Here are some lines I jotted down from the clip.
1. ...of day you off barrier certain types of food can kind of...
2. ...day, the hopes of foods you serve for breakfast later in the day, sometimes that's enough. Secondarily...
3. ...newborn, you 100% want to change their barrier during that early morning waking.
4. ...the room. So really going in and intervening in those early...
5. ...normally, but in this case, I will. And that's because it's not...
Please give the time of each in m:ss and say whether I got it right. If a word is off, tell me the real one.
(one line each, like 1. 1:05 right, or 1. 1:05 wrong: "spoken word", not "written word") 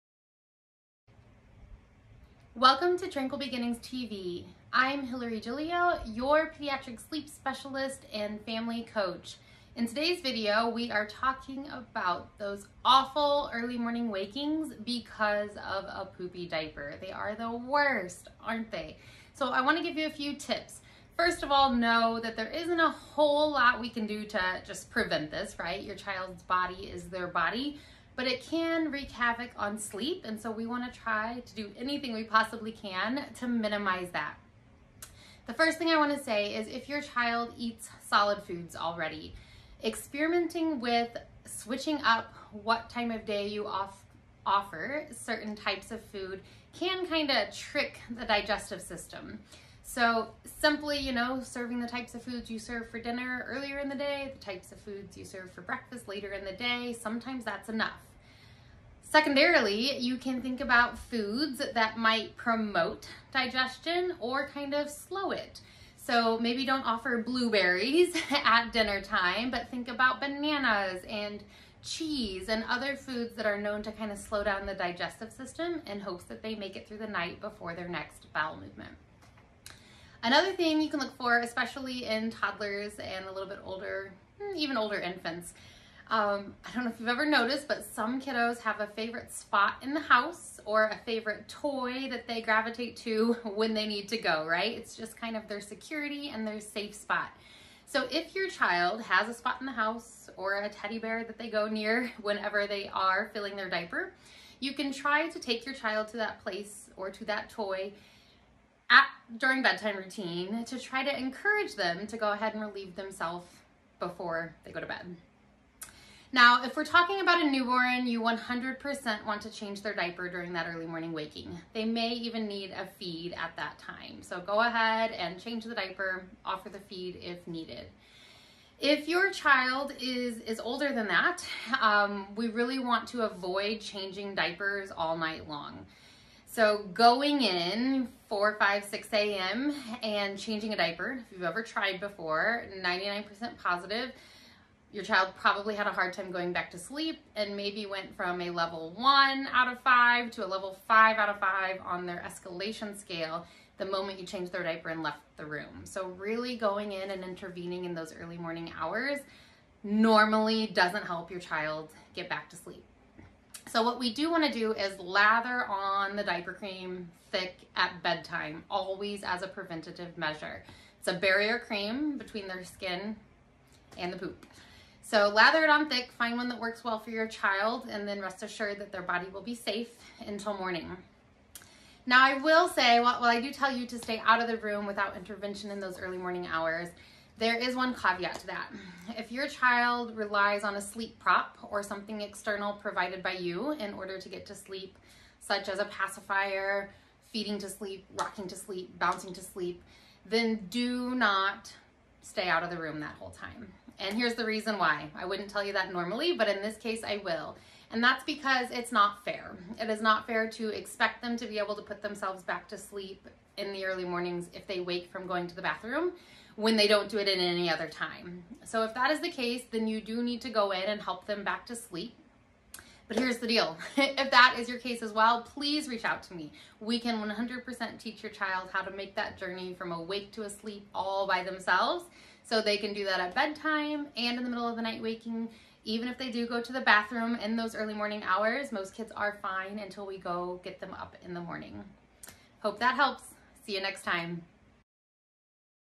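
1. 0:43 wrong: "offer", not "barrier"
2. 0:53 wrong: "types", not "hopes"
3. 1:57 wrong: "diaper", not "barrier"
4. 2:35 right
5. 3:25 right.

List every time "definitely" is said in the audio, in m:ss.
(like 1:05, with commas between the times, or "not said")
not said.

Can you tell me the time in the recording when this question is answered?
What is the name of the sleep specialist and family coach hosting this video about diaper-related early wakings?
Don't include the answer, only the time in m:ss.
0:05.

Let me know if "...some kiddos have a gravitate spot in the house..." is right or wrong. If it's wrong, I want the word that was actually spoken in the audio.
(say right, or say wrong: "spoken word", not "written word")
wrong: "favorite", not "gravitate".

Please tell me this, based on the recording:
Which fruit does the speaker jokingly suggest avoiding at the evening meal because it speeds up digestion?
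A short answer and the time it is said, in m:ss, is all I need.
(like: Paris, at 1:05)
blueberries, at 1:07.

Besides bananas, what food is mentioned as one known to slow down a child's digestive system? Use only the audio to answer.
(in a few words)
cheese.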